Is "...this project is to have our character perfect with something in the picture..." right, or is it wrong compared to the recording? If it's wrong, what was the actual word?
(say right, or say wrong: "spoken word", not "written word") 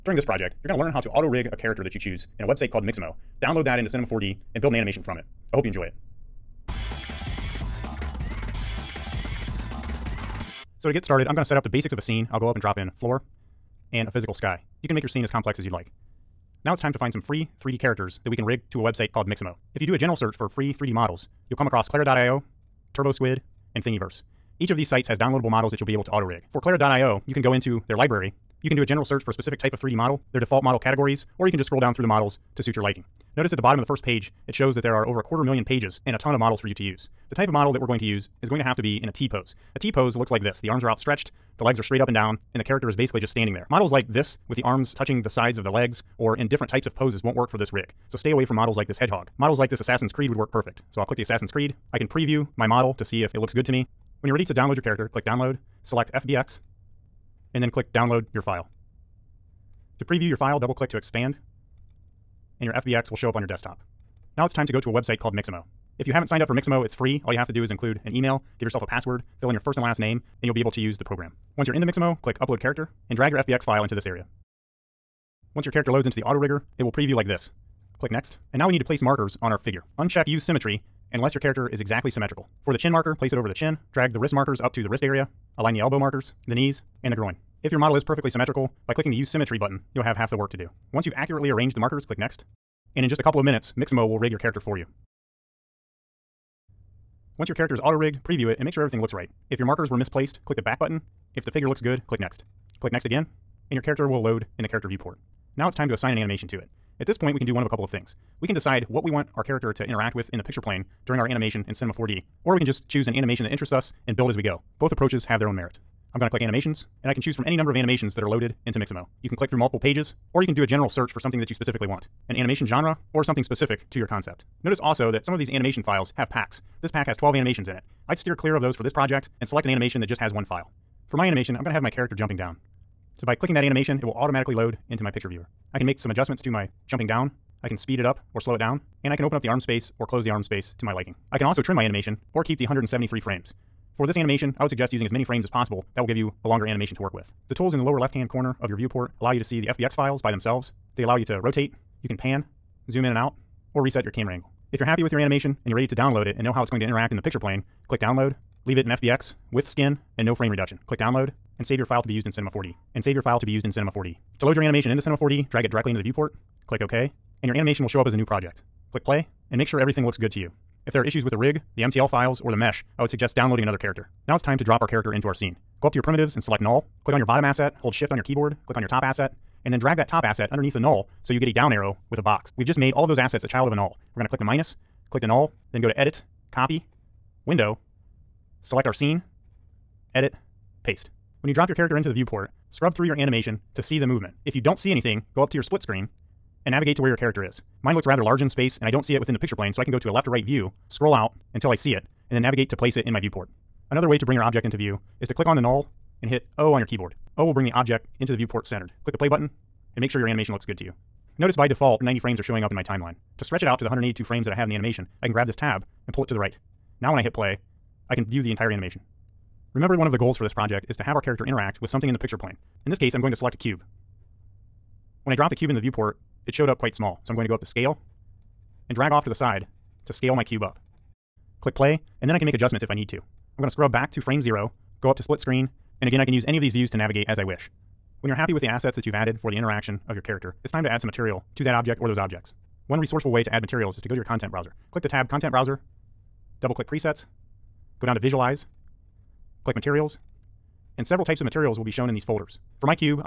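wrong: "interact", not "perfect".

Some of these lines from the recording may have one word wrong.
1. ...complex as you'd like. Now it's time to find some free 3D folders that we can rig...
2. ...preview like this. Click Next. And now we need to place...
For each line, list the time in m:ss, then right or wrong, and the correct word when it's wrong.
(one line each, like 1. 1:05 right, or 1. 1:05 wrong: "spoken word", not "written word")
1. 0:15 wrong: "characters", not "folders"
2. 1:16 right.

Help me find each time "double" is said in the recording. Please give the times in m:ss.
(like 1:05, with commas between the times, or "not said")
1:00, 4:06.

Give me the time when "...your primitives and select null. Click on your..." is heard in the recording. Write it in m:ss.
2:55.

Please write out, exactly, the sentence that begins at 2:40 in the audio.
Click download and save your file to be used in Cinema 4D.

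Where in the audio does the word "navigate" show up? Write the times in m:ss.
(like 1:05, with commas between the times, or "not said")
3:16, 3:22, 3:56.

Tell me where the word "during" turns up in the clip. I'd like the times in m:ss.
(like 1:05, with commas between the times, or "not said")
0:00, 1:51.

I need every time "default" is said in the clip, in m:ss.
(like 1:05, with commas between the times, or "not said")
0:30, 3:31.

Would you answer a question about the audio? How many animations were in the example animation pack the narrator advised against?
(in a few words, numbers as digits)
12.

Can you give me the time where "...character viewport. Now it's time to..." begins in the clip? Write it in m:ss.
1:44.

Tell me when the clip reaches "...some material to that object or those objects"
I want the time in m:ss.
4:01.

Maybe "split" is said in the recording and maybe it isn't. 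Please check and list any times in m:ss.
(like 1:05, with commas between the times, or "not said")
3:15, 3:55.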